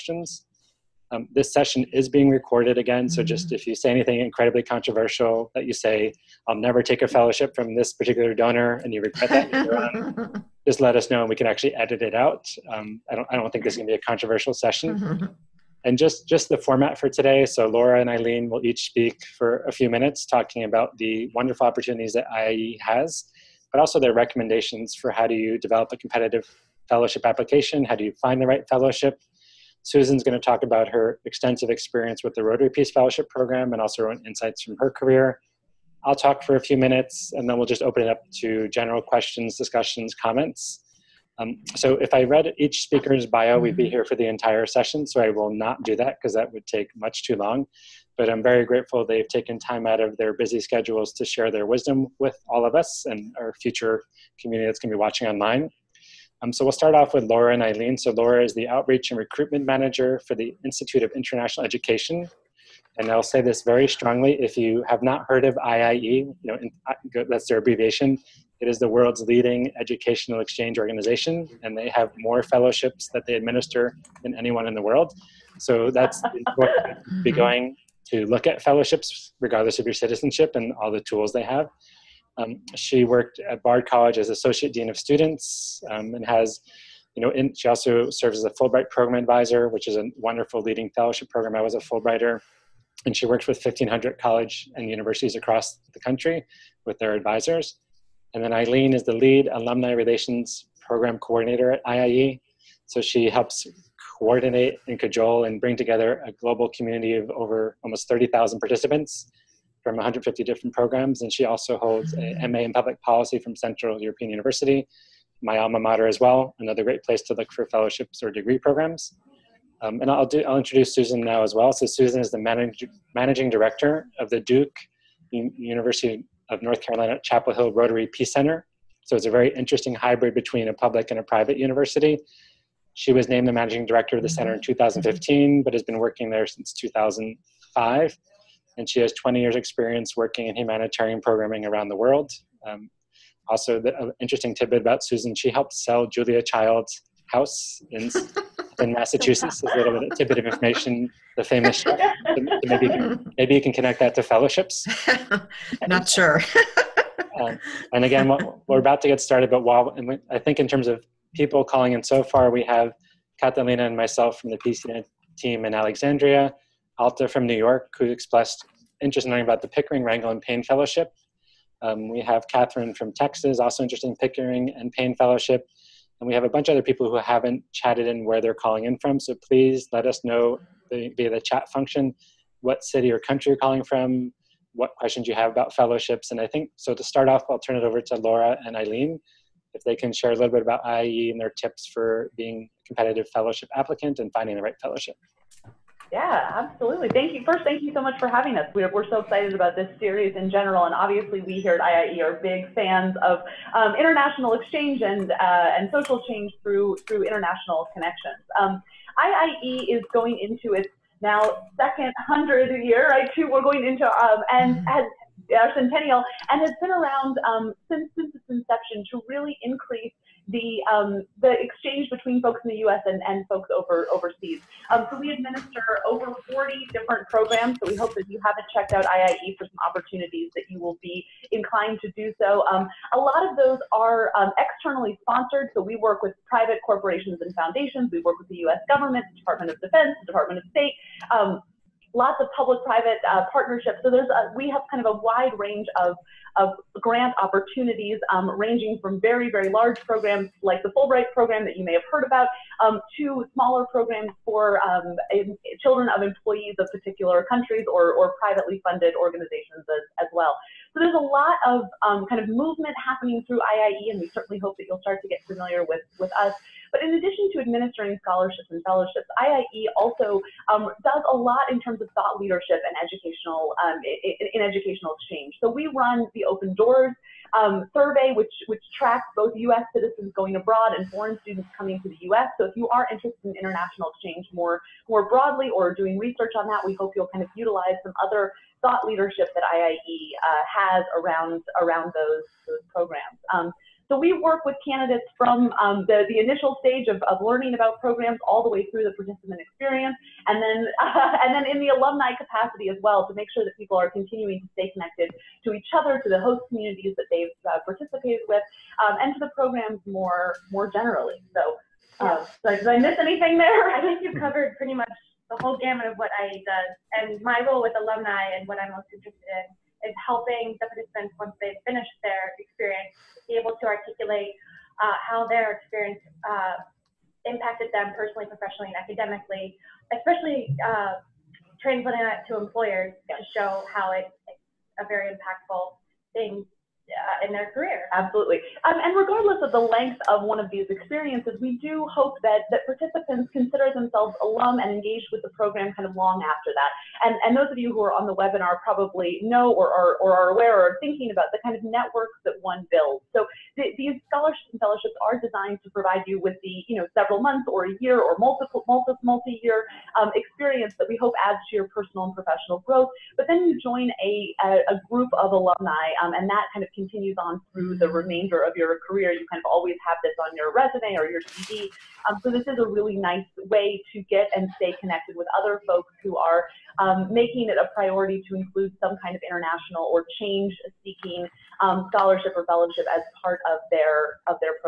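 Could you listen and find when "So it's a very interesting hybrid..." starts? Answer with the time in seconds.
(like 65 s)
129 s.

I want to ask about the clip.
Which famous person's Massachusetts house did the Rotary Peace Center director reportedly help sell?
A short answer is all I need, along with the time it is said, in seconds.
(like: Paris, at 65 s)
Julia Child, at 146 s.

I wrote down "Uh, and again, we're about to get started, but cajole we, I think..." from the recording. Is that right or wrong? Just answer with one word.
wrong.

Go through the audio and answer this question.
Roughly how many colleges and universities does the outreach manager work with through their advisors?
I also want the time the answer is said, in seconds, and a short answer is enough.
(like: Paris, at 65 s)
1,500, at 93 s.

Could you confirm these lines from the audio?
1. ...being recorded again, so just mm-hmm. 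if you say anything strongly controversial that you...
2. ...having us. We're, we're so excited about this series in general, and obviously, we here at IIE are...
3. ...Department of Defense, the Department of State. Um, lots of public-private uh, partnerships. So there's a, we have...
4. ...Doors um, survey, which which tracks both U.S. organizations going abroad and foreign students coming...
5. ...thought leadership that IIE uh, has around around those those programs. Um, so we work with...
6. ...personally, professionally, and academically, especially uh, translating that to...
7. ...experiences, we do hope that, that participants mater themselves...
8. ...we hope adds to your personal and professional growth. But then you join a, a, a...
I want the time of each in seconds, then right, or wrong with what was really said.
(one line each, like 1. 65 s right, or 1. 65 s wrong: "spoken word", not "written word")
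1. 2 s wrong: "incredibly", not "strongly"
2. 198 s right
3. 239 s right
4. 276 s wrong: "citizens", not "organizations"
5. 288 s right
6. 328 s right
7. 340 s wrong: "consider", not "mater"
8. 361 s right.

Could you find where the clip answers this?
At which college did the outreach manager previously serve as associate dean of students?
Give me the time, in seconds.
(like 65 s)
83 s.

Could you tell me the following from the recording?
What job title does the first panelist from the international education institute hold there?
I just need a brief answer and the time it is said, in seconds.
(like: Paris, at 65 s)
Outreach and Recruitment Manager, at 58 s.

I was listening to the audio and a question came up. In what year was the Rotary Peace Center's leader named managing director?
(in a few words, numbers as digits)
2015.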